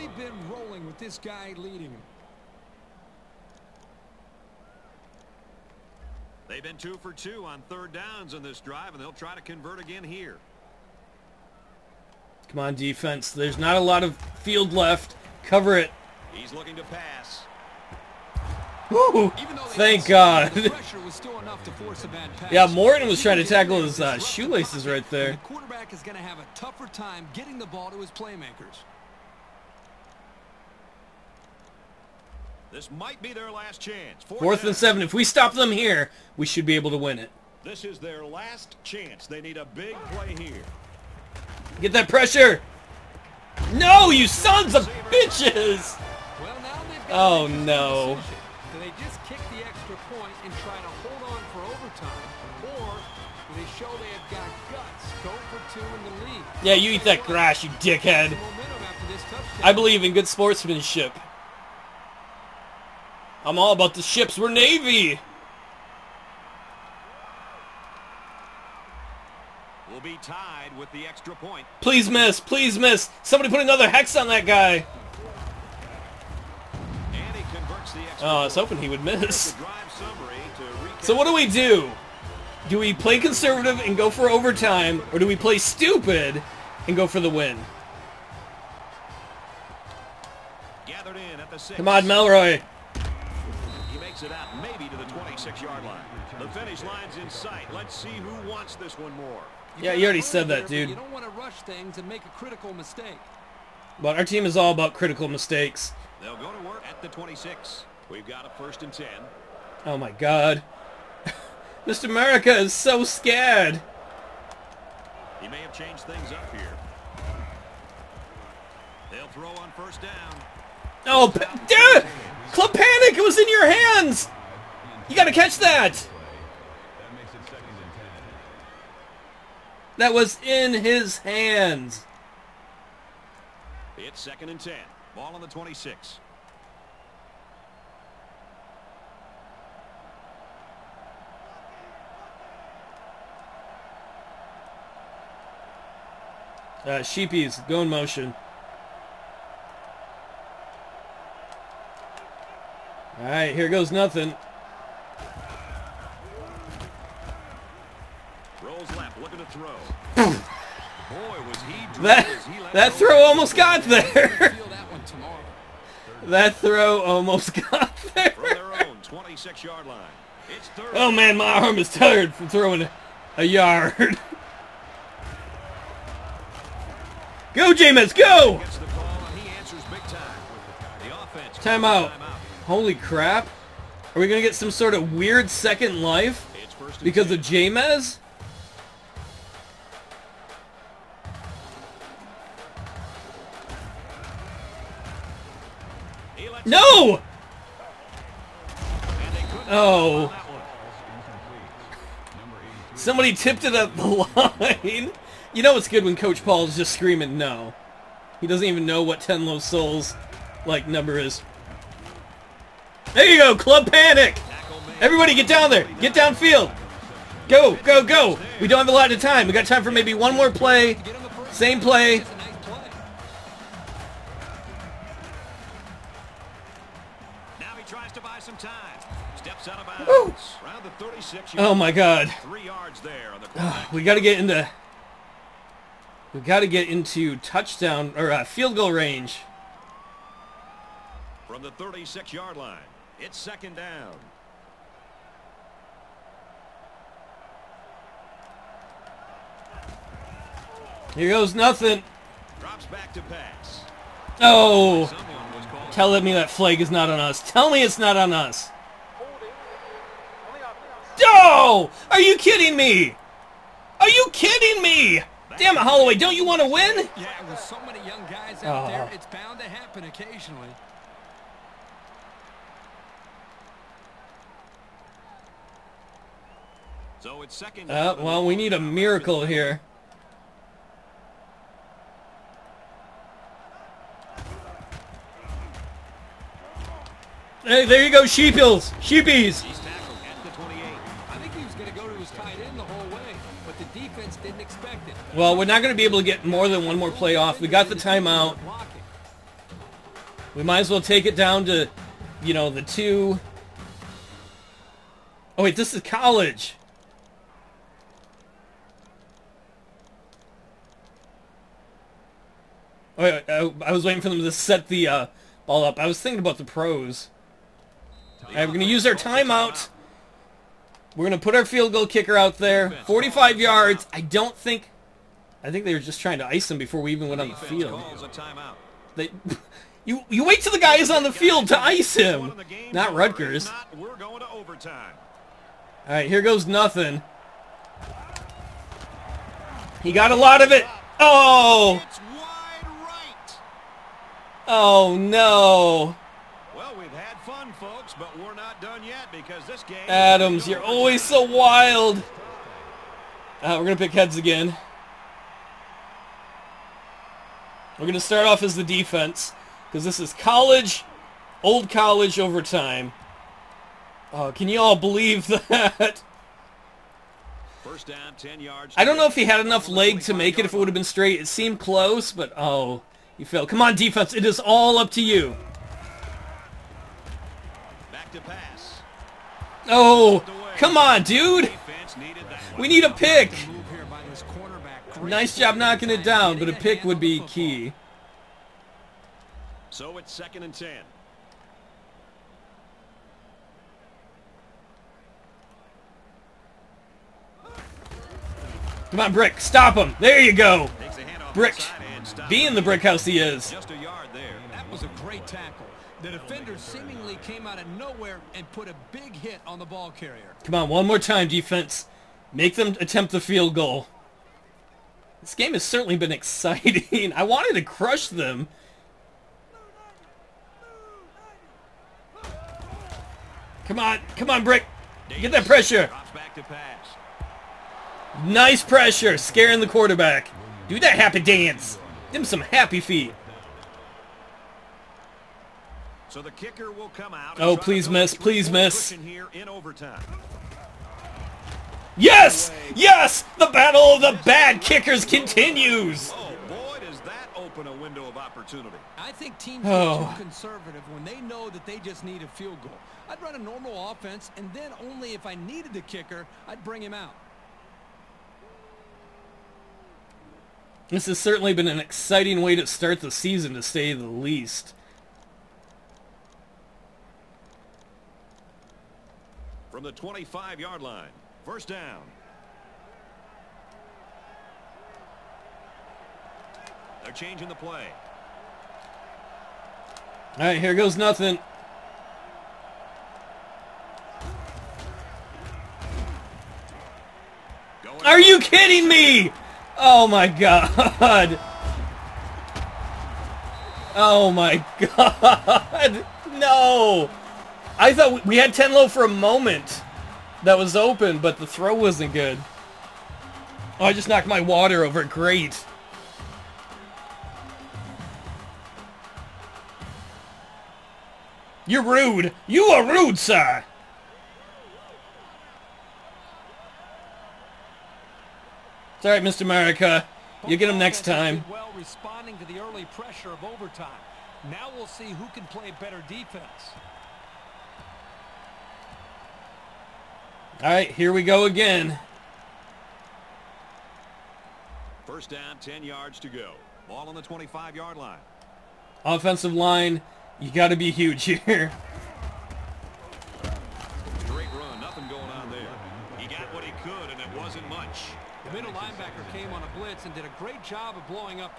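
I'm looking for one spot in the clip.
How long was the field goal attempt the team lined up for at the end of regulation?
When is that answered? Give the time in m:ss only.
5:23.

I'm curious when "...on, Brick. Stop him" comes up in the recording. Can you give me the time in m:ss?
6:39.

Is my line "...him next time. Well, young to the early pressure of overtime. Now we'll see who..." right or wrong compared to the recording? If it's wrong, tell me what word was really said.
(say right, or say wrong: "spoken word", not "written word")
wrong: "responding", not "young".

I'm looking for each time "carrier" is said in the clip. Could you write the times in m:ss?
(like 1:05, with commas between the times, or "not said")
6:50.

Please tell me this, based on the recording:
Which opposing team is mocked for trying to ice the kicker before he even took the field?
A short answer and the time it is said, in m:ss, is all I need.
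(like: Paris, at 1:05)
Rutgers, at 5:33.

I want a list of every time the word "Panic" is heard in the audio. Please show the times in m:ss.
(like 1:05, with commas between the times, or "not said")
2:02, 3:33.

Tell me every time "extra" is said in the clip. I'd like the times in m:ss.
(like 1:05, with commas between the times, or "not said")
0:49, 1:11.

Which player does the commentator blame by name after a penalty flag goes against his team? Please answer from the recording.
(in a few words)
Holloway.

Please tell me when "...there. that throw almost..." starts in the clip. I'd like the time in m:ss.
2:43.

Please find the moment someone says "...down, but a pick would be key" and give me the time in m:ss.
6:26.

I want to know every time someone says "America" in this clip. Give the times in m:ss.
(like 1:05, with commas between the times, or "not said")
1:52, 8:39.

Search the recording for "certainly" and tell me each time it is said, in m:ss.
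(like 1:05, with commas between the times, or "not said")
6:55, 7:41.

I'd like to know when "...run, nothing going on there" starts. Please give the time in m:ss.
9:04.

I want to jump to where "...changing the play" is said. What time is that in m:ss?
7:57.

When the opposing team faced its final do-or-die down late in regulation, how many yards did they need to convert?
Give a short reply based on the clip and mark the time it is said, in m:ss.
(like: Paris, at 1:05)
7, at 0:34.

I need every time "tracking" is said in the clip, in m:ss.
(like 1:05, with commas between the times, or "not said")
not said.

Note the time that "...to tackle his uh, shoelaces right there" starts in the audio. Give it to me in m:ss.
0:23.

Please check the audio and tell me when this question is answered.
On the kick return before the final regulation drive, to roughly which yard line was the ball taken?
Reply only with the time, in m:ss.
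1:35.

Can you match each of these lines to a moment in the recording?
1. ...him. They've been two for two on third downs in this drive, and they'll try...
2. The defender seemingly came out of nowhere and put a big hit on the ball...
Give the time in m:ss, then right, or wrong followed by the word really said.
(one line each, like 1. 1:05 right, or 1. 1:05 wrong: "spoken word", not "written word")
1. 0:01 right
2. 6:46 right.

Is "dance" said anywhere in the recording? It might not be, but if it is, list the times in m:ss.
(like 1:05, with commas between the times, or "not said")
7:11.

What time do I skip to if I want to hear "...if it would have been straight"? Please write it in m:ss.
6:10.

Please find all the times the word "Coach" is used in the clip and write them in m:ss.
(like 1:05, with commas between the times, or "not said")
3:26.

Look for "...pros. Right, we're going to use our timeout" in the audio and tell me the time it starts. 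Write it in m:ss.
5:16.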